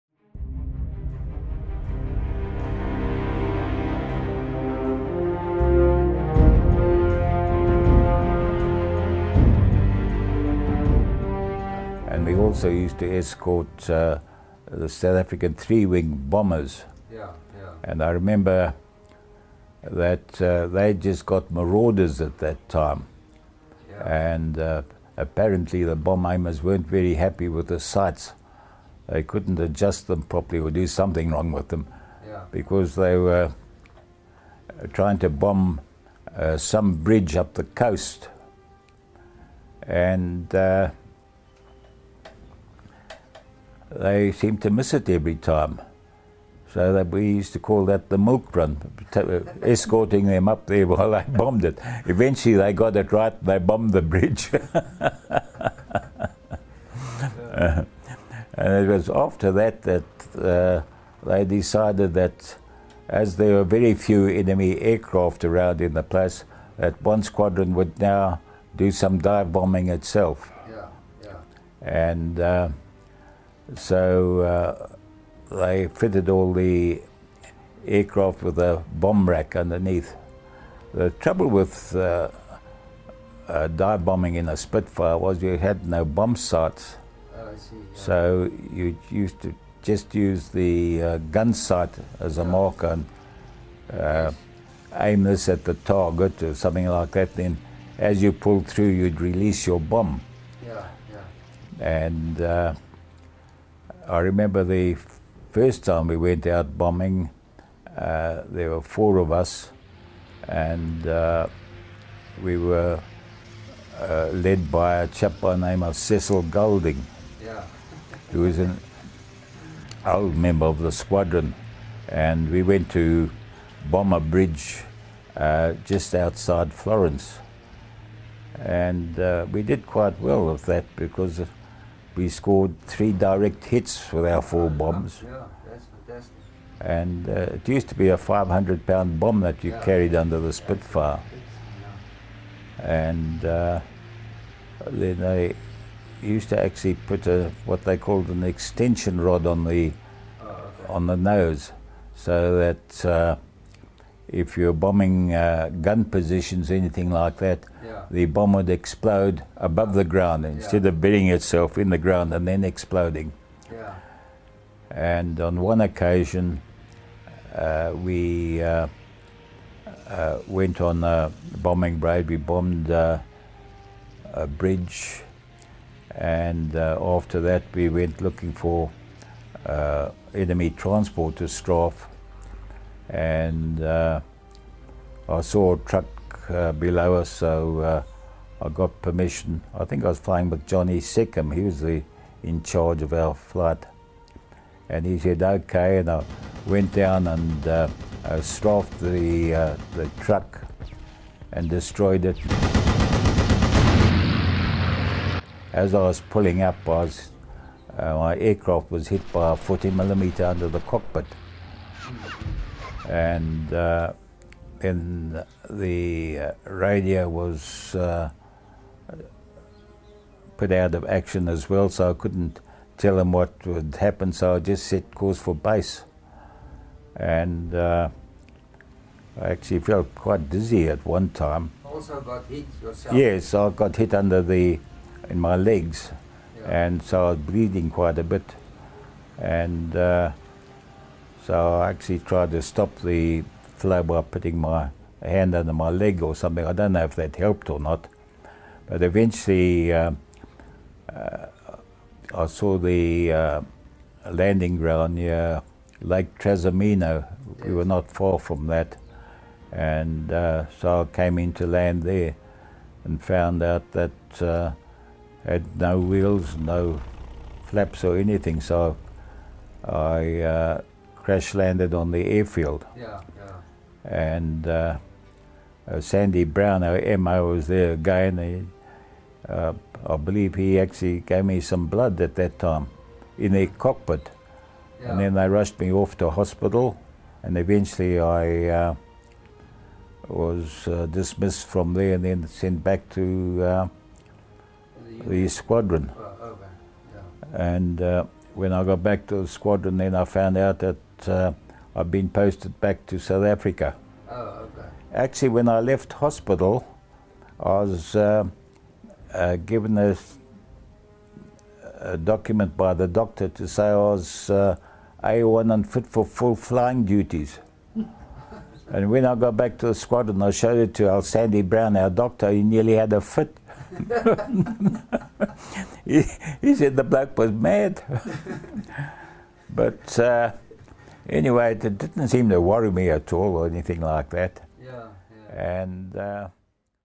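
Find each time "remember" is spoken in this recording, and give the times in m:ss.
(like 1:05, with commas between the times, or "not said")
0:18, 1:44.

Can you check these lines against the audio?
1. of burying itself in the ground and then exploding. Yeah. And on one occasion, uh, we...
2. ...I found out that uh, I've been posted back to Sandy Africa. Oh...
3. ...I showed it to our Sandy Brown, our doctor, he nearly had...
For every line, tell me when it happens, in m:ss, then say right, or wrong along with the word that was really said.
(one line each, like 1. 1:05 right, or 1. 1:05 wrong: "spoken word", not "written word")
1. 2:40 right
2. 5:00 wrong: "South", not "Sandy"
3. 5:20 right.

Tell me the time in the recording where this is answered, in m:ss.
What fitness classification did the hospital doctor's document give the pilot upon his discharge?
5:15.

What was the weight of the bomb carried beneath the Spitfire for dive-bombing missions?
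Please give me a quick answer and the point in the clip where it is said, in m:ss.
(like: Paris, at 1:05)
500 pounds, at 2:18.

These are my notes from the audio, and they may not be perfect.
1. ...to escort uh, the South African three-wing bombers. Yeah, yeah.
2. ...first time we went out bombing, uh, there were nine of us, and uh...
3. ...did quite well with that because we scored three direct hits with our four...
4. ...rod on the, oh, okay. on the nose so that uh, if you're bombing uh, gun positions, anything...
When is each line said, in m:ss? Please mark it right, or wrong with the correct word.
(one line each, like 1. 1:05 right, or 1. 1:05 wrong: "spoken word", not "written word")
1. 0:12 right
2. 1:45 wrong: "four", not "nine"
3. 2:09 right
4. 2:29 right.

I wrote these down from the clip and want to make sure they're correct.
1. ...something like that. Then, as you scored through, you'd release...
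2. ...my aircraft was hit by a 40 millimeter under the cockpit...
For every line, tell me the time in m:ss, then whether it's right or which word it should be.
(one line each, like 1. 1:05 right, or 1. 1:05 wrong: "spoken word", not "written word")
1. 1:36 wrong: "pulled", not "scored"
2. 3:28 right.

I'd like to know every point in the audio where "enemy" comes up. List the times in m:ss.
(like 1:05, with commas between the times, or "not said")
1:04, 3:00.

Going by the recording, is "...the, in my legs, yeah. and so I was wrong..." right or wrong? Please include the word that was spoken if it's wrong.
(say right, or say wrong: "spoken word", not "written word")
wrong: "bleeding", not "wrong".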